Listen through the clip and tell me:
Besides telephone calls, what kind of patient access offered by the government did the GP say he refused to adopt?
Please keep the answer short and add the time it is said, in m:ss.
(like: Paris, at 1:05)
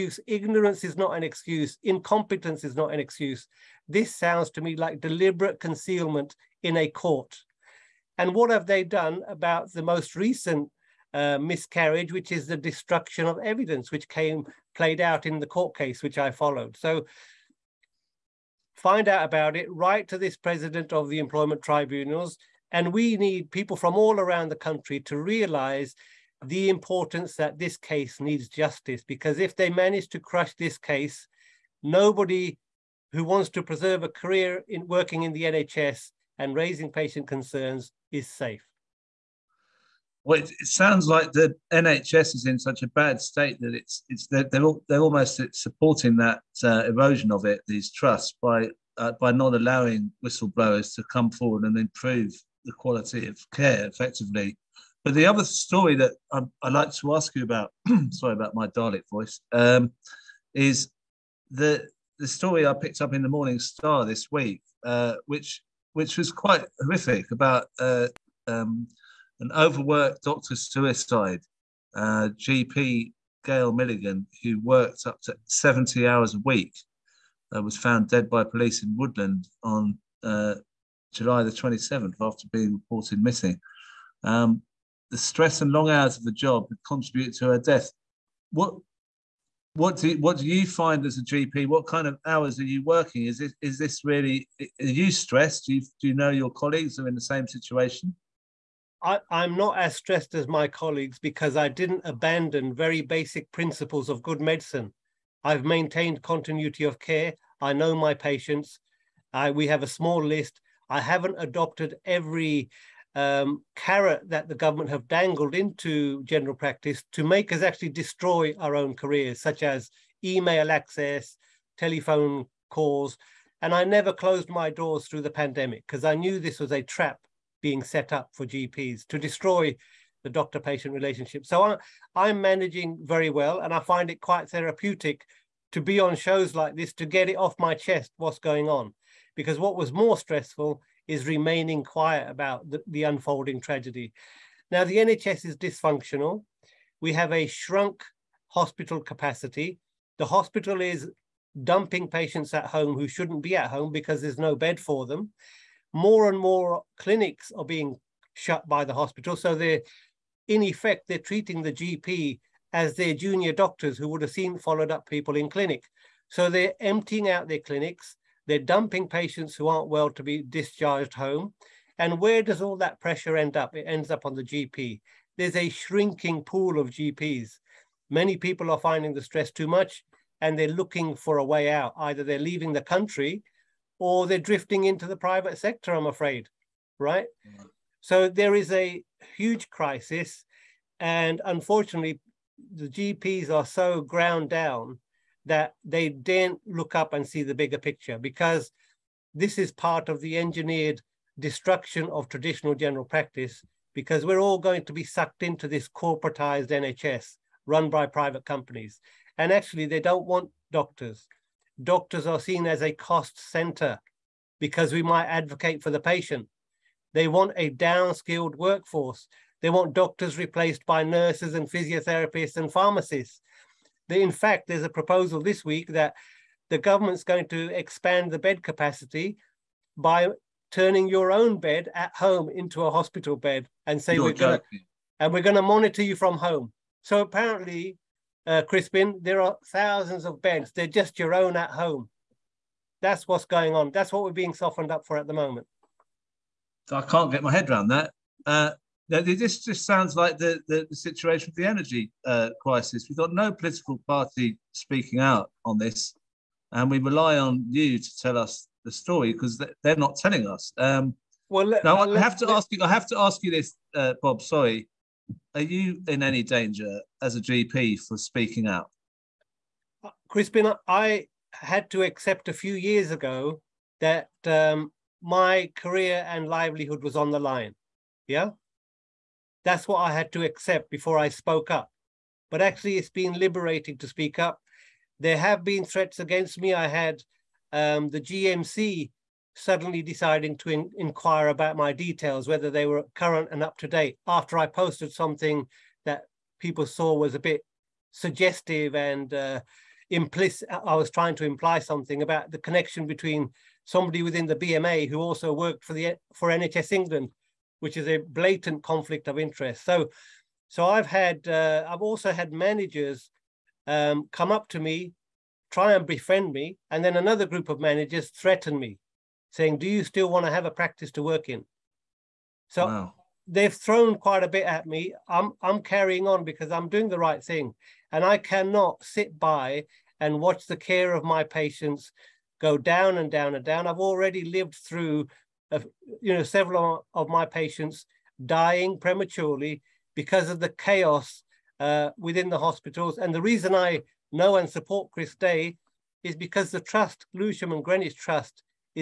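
Email access, at 2:00.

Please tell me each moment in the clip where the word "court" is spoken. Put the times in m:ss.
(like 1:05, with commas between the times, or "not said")
0:06, 0:15.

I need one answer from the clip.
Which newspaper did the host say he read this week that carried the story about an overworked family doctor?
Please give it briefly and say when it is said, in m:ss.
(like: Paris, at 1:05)
Morning Star, at 1:03.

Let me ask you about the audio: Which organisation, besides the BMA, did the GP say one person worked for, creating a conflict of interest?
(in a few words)
NHS England.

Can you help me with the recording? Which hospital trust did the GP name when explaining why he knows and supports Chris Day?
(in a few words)
Lewisham and Greenwich Trust.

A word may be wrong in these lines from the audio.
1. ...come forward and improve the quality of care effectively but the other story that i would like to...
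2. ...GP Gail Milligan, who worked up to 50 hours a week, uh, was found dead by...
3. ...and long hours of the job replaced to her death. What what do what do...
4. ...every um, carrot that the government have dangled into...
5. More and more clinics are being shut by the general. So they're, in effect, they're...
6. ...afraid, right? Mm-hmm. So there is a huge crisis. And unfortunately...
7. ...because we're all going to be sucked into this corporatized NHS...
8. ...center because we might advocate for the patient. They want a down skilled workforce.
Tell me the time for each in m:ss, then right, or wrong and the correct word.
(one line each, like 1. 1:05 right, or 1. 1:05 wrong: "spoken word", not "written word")
1. 0:51 right
2. 1:12 wrong: "70", not "50"
3. 1:25 wrong: "contributed", not "replaced"
4. 1:52 right
5. 2:35 wrong: "hospital", not "general"
6. 3:06 right
7. 3:23 right
8. 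3:33 right.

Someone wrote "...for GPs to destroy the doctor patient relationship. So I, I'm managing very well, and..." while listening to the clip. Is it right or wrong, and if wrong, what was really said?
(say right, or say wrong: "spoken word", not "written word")
right.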